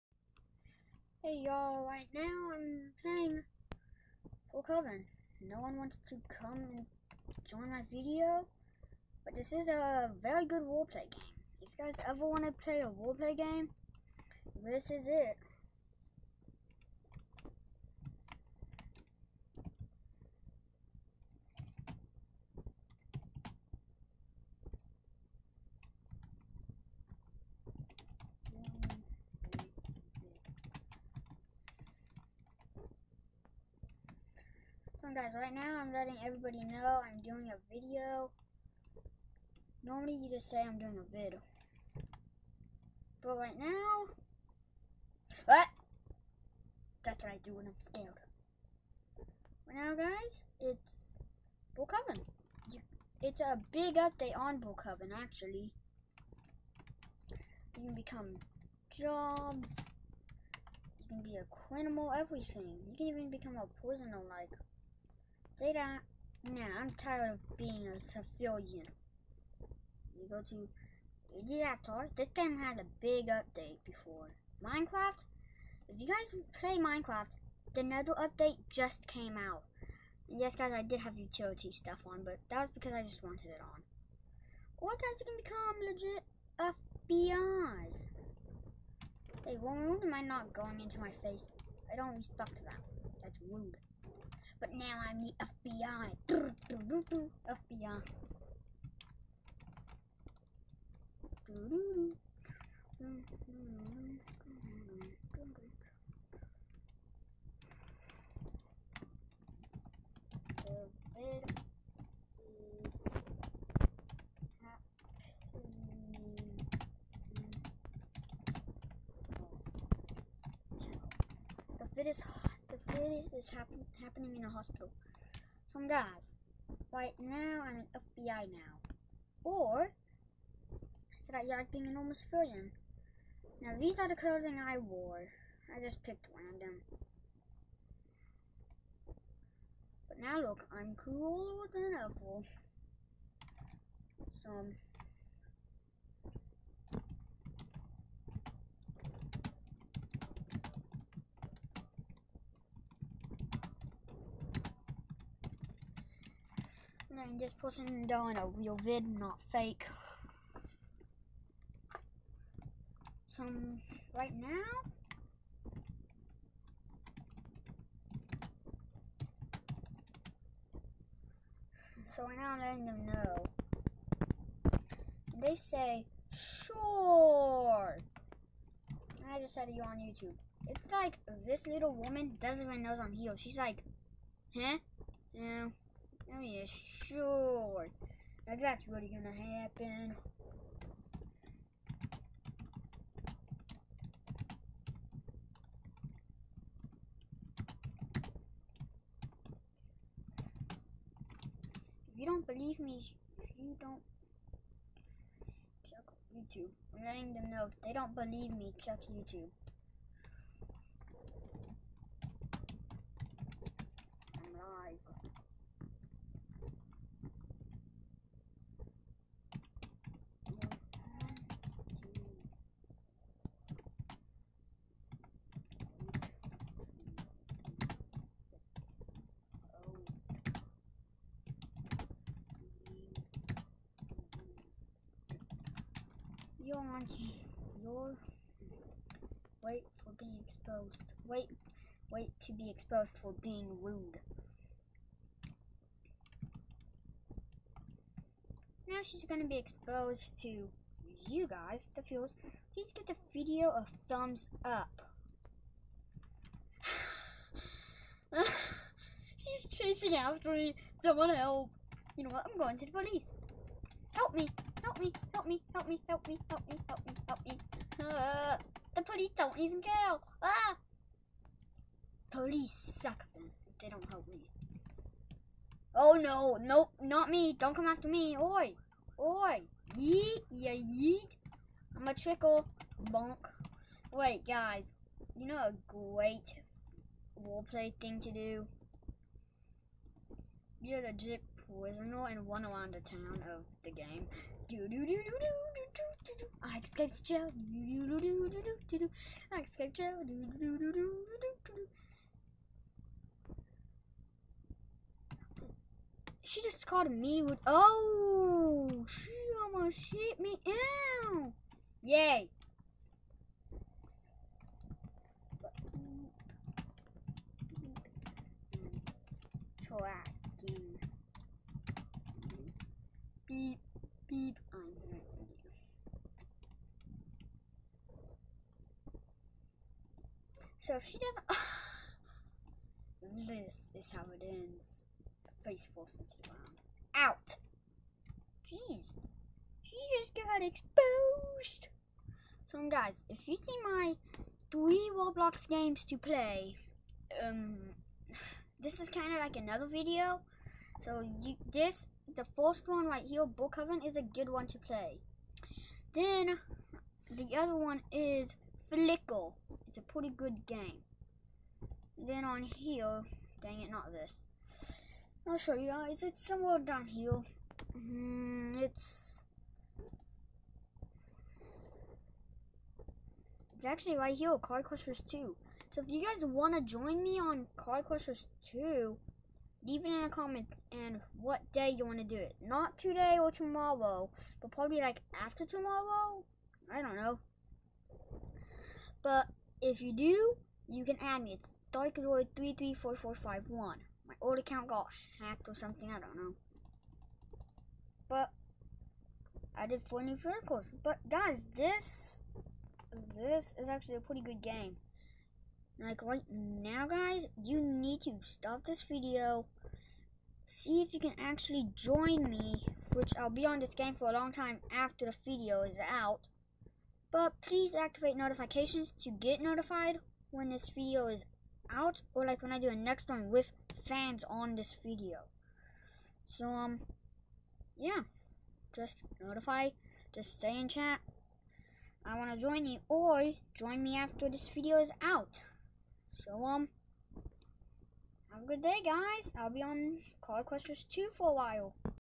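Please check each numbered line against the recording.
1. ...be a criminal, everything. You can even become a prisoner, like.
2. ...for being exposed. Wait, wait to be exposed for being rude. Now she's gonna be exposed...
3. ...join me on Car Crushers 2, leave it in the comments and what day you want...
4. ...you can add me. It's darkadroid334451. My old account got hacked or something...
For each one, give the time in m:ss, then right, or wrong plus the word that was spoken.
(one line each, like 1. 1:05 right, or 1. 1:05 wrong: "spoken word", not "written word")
1. 1:01 right
2. 4:00 right
3. 6:16 right
4. 6:30 right.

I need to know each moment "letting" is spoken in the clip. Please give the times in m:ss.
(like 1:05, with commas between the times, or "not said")
0:35, 2:52, 3:27.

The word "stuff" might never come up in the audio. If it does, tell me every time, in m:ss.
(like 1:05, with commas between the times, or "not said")
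1:21.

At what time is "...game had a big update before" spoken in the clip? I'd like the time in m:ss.
1:12.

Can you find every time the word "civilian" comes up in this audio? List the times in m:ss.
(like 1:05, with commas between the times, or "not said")
1:08, 2:12.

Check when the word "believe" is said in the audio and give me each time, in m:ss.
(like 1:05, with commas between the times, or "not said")
3:22, 3:28.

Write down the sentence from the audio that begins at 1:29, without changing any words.
They won't mind not going into my face.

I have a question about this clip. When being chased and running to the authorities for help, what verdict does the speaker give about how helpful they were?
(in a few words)
Police suck.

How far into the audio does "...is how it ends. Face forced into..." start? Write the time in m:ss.
5:33.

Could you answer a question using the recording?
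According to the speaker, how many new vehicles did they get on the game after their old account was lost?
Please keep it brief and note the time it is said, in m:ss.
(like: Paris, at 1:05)
4, at 6:40.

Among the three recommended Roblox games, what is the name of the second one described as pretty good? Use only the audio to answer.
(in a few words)
Flickle.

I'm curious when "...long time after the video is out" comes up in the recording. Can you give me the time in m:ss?
6:54.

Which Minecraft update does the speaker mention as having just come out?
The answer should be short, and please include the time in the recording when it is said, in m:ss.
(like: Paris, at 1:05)
Nether update, at 1:17.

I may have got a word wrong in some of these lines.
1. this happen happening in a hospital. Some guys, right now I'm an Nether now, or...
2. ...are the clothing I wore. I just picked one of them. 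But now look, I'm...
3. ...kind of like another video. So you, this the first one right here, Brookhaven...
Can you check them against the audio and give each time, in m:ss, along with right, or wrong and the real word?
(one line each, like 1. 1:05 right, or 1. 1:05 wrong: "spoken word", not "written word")
1. 2:03 wrong: "FBI", not "Nether"
2. 2:13 right
3. 5:49 right.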